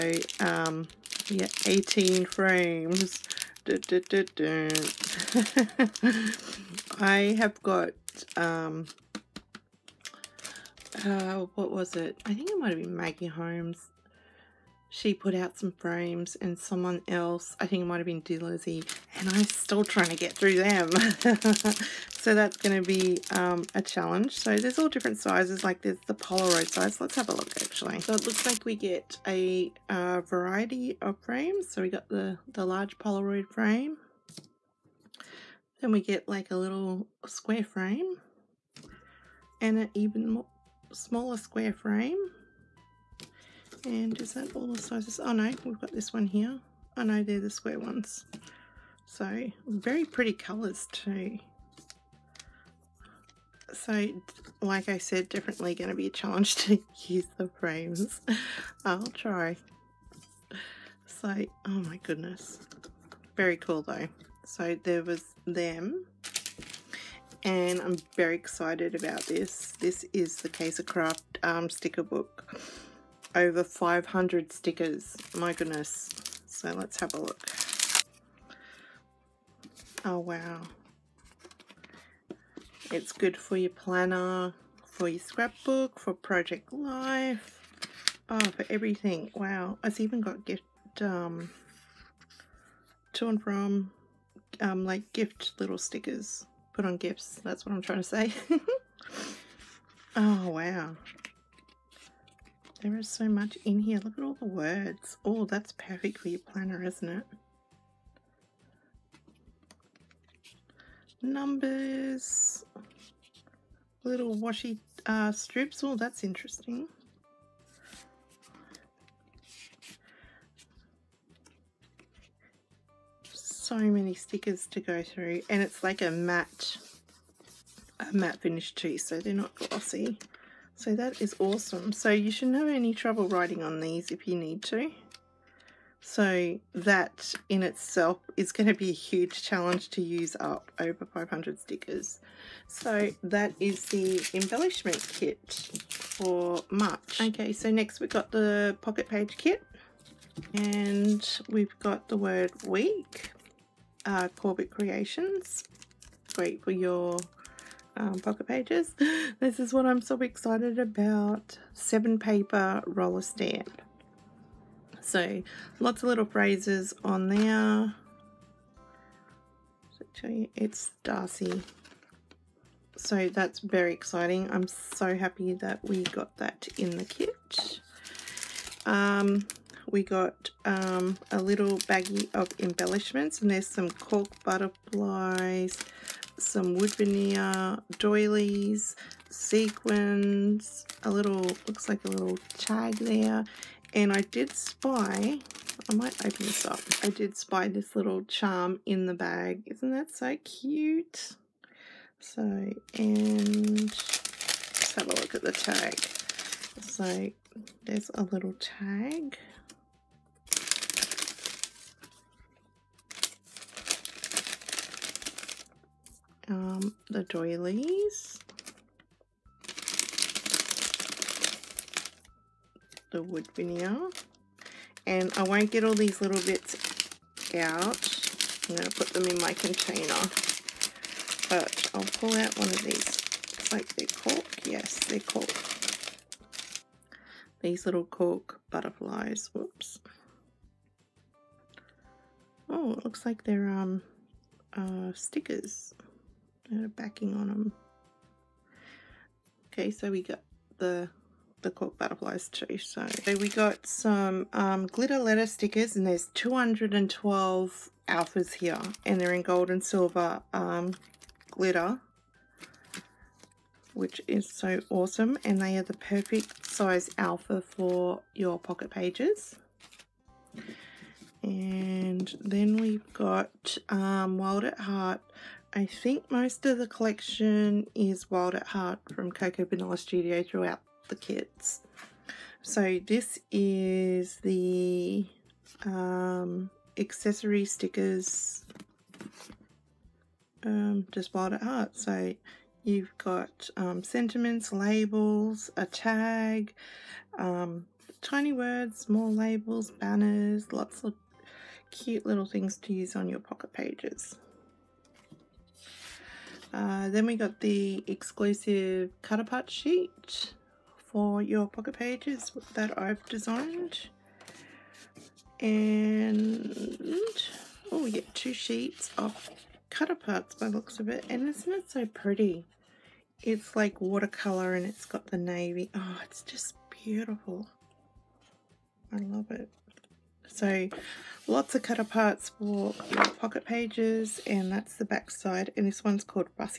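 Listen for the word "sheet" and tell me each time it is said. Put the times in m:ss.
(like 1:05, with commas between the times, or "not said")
5:09, 5:18.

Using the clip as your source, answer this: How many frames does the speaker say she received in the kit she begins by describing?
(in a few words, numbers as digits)
18.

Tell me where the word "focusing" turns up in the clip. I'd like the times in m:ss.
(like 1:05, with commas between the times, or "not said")
not said.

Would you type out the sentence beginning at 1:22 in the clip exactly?
It's good for your planner, for your scrapbook, for project life.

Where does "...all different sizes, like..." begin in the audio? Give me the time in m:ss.
0:24.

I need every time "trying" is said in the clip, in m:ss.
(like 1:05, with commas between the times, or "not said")
0:19, 1:37.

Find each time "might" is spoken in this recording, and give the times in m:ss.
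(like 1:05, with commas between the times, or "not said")
0:12, 0:17, 3:15.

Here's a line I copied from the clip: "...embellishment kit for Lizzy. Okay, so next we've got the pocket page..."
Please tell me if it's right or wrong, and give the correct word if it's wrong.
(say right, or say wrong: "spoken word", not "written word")
wrong: "March", not "Lizzy".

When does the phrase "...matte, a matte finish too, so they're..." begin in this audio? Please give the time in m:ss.
2:06.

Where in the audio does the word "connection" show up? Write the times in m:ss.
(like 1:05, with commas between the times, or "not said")
not said.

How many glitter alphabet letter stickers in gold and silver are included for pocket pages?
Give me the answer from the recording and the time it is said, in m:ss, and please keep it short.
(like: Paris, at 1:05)
212, at 4:16.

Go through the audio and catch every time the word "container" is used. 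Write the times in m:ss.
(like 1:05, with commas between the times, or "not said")
3:49.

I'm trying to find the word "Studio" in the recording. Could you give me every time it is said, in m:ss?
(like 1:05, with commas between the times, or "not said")
4:39.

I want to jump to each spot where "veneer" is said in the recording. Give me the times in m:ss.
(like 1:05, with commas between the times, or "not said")
3:06, 3:43.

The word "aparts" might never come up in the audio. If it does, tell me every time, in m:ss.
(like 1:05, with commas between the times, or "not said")
5:09, 5:20, 5:31.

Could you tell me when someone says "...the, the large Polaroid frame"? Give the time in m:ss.
0:32.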